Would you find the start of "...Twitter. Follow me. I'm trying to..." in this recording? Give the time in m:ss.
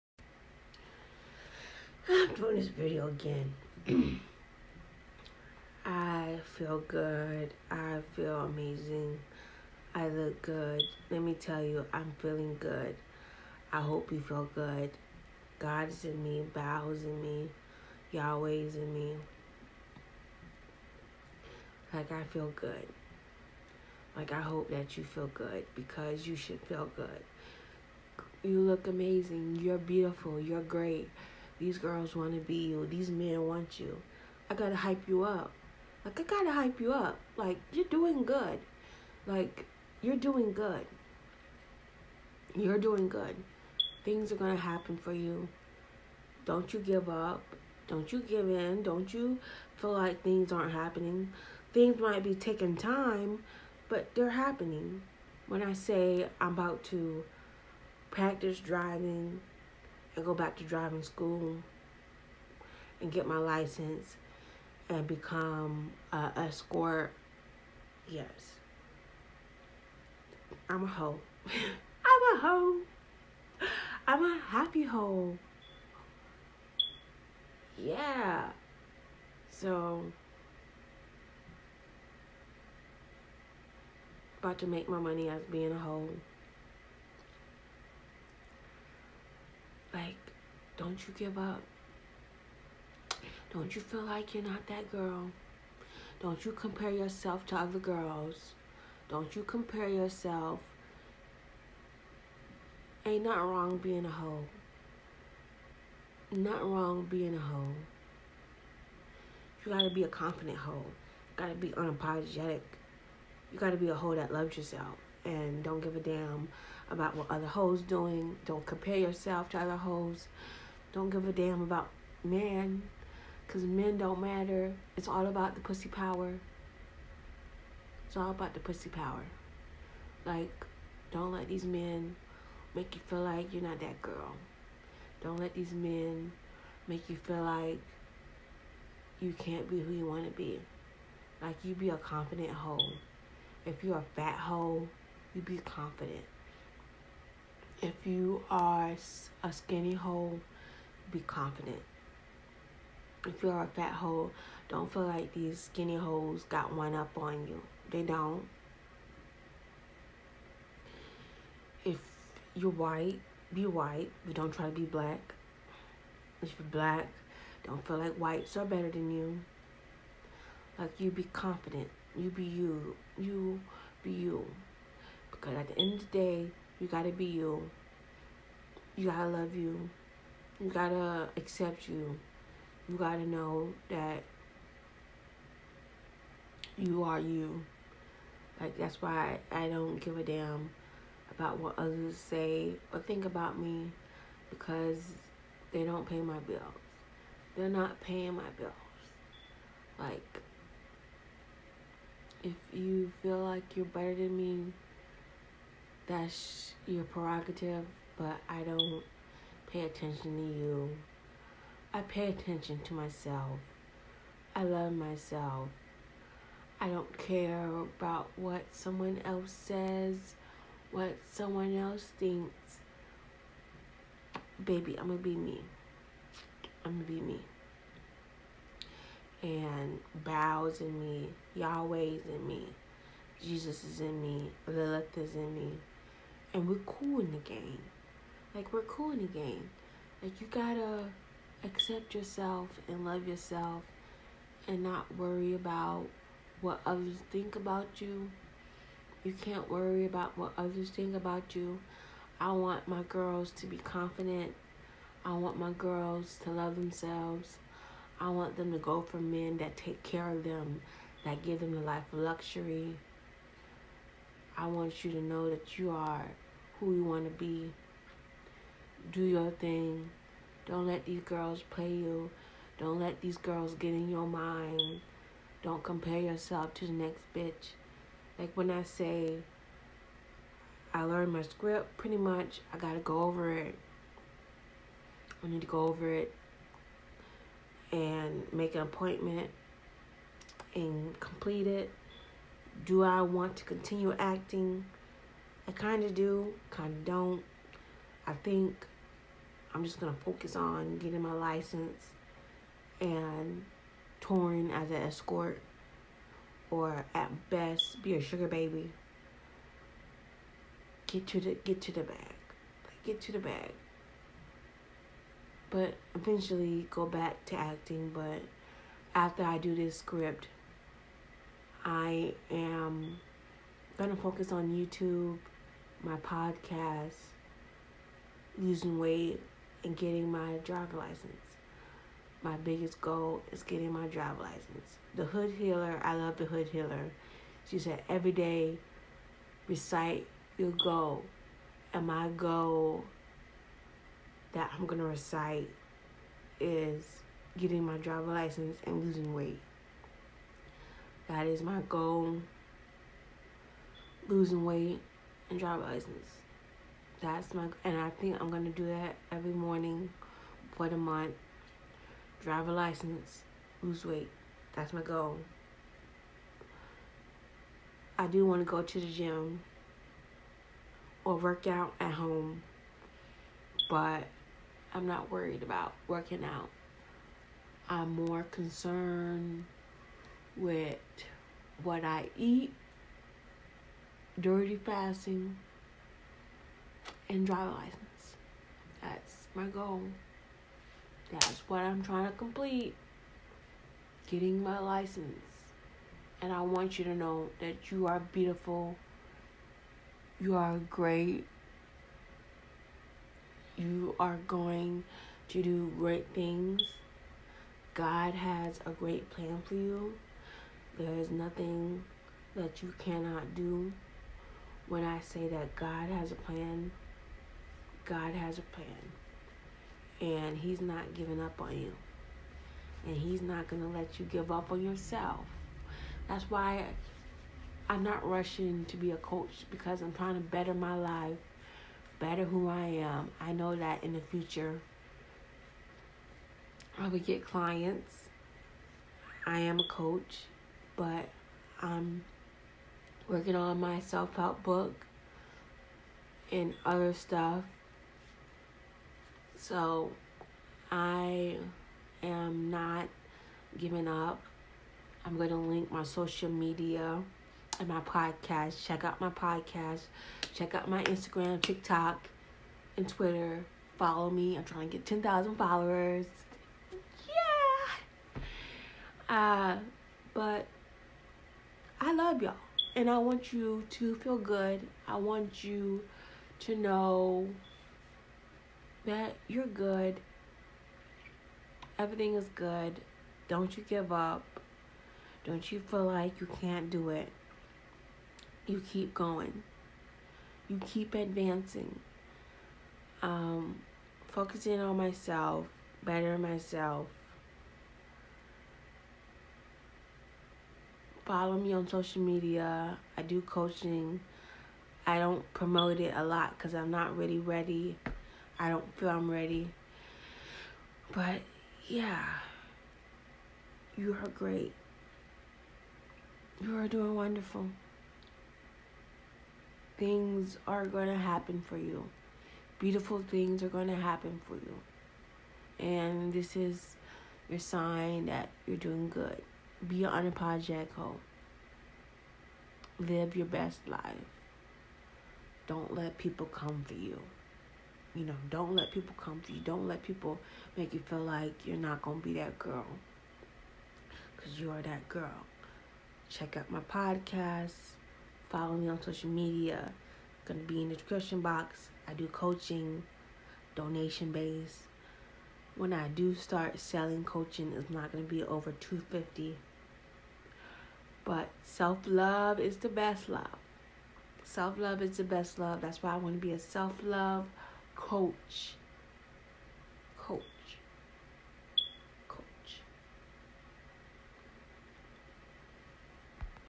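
7:43.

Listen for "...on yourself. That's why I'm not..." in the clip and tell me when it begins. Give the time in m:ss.
7:04.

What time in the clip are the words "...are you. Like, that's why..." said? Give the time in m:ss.
3:07.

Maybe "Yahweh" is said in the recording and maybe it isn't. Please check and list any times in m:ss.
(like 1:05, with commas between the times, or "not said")
0:18, 3:51.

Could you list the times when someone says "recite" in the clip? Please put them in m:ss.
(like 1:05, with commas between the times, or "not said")
5:39, 5:45.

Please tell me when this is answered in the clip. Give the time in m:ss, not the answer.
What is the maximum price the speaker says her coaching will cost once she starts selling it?
9:18.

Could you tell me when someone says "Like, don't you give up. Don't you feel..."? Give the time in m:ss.
1:29.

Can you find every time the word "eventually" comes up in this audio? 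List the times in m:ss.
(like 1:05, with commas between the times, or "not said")
5:16.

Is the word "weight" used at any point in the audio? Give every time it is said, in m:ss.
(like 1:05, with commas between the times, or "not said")
5:28, 5:49, 5:54, 6:04.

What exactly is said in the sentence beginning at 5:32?
My biggest goal is getting my driver license.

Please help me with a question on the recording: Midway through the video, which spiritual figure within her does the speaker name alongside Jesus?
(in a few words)
Lilith.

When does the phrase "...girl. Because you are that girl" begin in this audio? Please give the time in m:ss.
9:02.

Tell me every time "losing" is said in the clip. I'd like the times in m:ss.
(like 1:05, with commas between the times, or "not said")
5:28, 5:49, 5:54.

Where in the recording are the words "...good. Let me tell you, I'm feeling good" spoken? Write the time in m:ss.
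0:10.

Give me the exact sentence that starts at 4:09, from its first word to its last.
You can't worry about what others think about you.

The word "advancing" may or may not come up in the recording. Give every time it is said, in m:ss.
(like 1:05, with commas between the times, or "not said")
8:11.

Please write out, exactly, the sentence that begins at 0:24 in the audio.
Like, I hope that you feel good because you should feel good.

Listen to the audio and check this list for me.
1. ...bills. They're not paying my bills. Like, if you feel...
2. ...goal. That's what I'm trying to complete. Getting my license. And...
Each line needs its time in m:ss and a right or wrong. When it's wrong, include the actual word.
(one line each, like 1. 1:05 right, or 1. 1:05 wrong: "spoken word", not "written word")
1. 3:16 right
2. 6:29 right.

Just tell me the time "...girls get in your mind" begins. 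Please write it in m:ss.
4:33.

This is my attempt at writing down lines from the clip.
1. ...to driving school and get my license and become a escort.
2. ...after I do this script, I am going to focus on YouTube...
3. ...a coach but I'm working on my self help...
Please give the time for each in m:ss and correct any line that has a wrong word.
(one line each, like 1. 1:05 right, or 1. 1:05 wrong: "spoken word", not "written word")
1. 1:00 right
2. 5:19 right
3. 7:19 right.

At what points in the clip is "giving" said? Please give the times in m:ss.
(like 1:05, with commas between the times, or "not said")
7:01, 7:33.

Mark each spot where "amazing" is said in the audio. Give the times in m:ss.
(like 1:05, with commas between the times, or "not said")
0:08, 0:28.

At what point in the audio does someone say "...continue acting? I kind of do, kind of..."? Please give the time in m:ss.
4:53.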